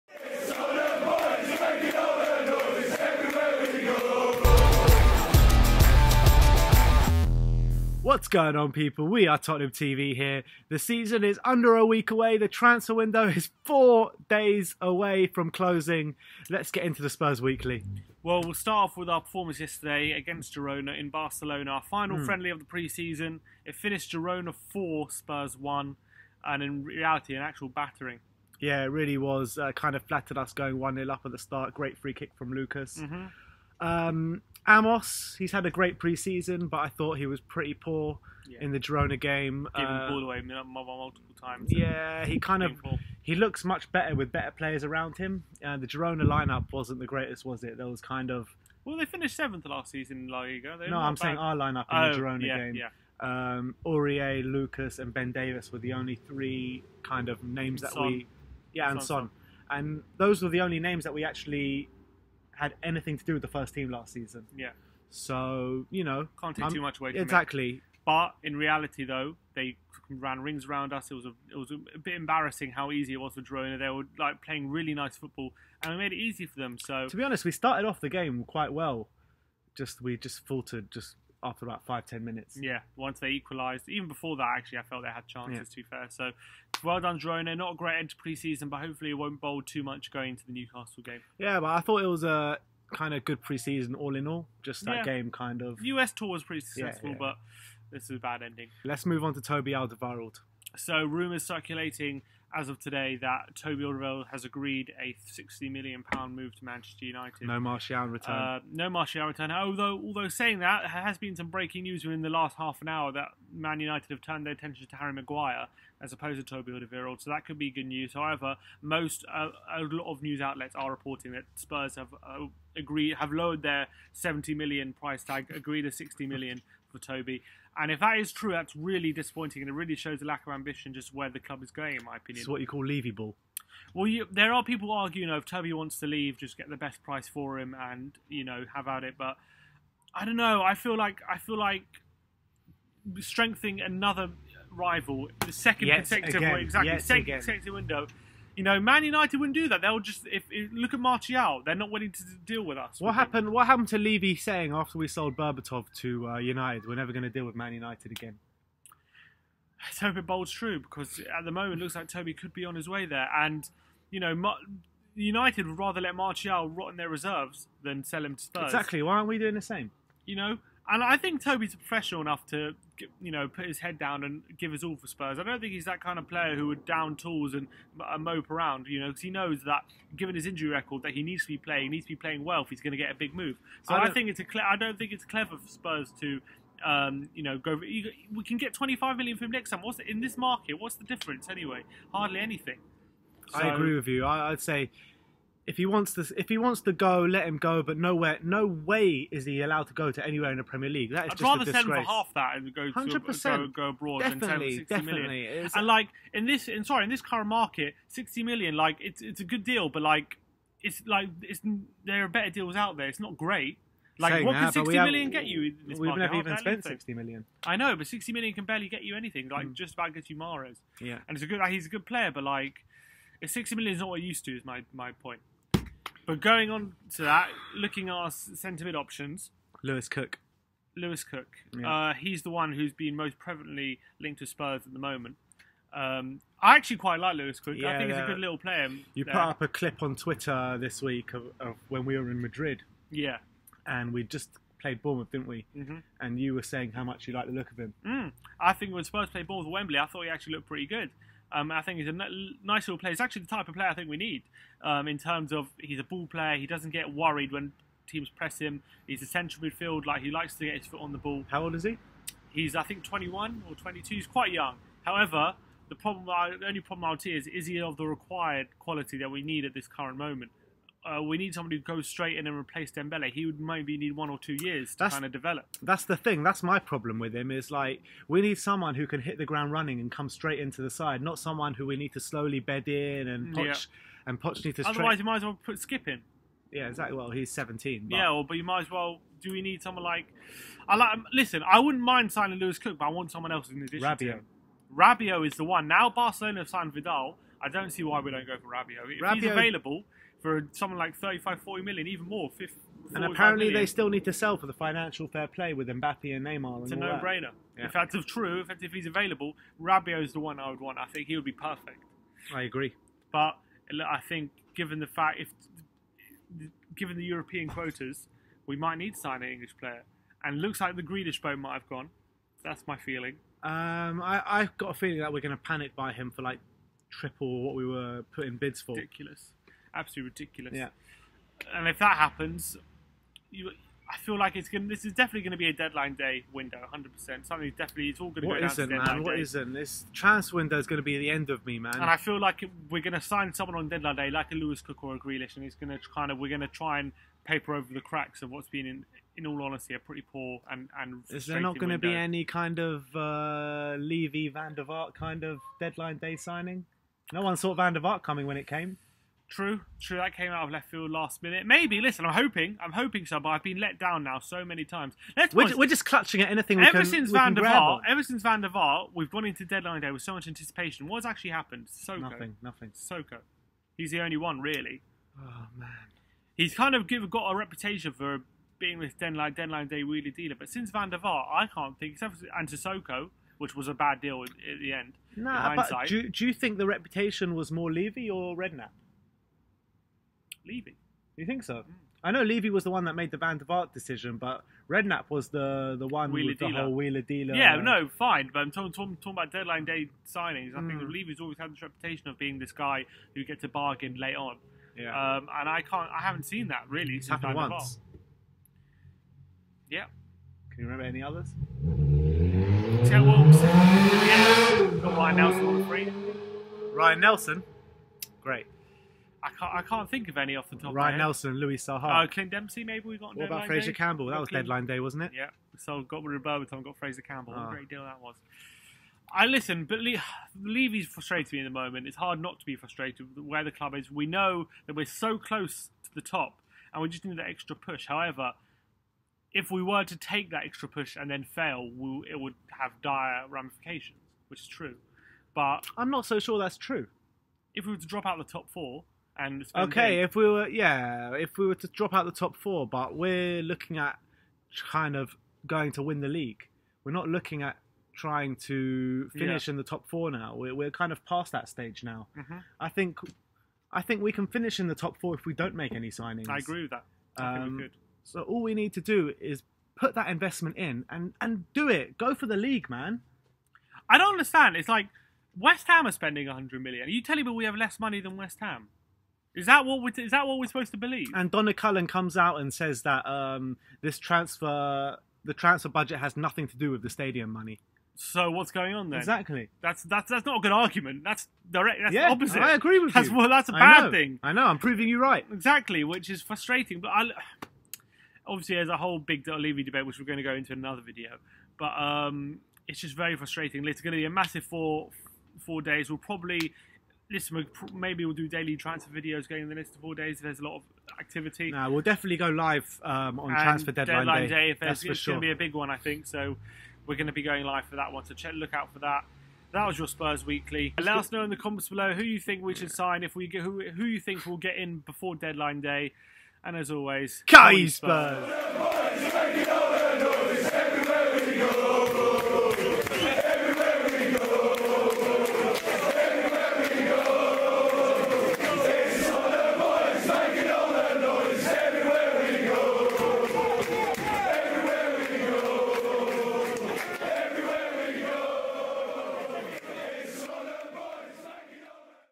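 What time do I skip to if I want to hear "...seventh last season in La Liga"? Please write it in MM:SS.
00:49.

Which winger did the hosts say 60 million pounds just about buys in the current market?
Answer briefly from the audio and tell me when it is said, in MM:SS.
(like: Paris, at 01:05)
Mahrez, at 03:40.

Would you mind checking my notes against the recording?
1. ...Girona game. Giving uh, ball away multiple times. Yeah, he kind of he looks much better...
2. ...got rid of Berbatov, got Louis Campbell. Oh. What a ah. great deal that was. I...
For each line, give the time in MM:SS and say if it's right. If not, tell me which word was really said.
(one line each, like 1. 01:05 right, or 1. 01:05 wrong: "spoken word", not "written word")
1. 00:38 right
2. 07:06 wrong: "Fraser", not "Louis".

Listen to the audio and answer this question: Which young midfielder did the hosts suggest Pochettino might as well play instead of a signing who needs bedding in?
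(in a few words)
Skipp.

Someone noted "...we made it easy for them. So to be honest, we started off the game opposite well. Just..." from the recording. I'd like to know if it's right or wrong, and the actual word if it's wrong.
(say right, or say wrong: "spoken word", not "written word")
wrong: "quite", not "opposite".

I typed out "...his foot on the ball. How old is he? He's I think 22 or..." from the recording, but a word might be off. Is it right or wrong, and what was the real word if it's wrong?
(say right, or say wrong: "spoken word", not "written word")
wrong: "21", not "22".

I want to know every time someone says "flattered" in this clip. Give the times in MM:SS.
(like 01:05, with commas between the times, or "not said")
00:30.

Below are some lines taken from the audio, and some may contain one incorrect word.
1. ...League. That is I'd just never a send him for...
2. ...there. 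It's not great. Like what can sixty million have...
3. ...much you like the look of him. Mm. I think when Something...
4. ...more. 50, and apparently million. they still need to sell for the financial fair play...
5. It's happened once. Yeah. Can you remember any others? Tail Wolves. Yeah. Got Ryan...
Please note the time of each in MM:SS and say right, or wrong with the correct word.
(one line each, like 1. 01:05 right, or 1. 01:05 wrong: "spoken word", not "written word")
1. 03:20 wrong: "rather", not "never"
2. 03:32 right
3. 04:07 wrong: "Spurs", not "Something"
4. 05:02 right
5. 06:47 right.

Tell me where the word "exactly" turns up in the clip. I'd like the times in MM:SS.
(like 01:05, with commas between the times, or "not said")
01:07, 02:26, 02:48, 04:46, 08:09, 08:15.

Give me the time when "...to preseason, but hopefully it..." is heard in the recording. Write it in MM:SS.
01:28.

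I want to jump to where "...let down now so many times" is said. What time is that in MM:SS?
06:03.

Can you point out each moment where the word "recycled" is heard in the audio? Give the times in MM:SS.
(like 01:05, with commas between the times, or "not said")
not said.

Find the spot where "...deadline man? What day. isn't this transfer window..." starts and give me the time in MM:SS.
05:38.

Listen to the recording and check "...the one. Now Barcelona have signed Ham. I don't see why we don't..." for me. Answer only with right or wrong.
wrong.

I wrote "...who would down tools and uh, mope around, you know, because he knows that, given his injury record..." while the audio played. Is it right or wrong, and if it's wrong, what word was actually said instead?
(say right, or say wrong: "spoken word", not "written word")
right.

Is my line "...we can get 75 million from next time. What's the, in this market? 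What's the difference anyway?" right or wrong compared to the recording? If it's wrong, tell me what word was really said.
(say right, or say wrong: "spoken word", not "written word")
wrong: "25", not "75".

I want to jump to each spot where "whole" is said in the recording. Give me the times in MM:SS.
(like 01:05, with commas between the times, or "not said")
06:36, 08:18.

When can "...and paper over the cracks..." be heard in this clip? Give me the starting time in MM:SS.
05:46.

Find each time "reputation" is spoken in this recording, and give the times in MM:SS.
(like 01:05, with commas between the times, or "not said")
06:17, 06:26, 06:41.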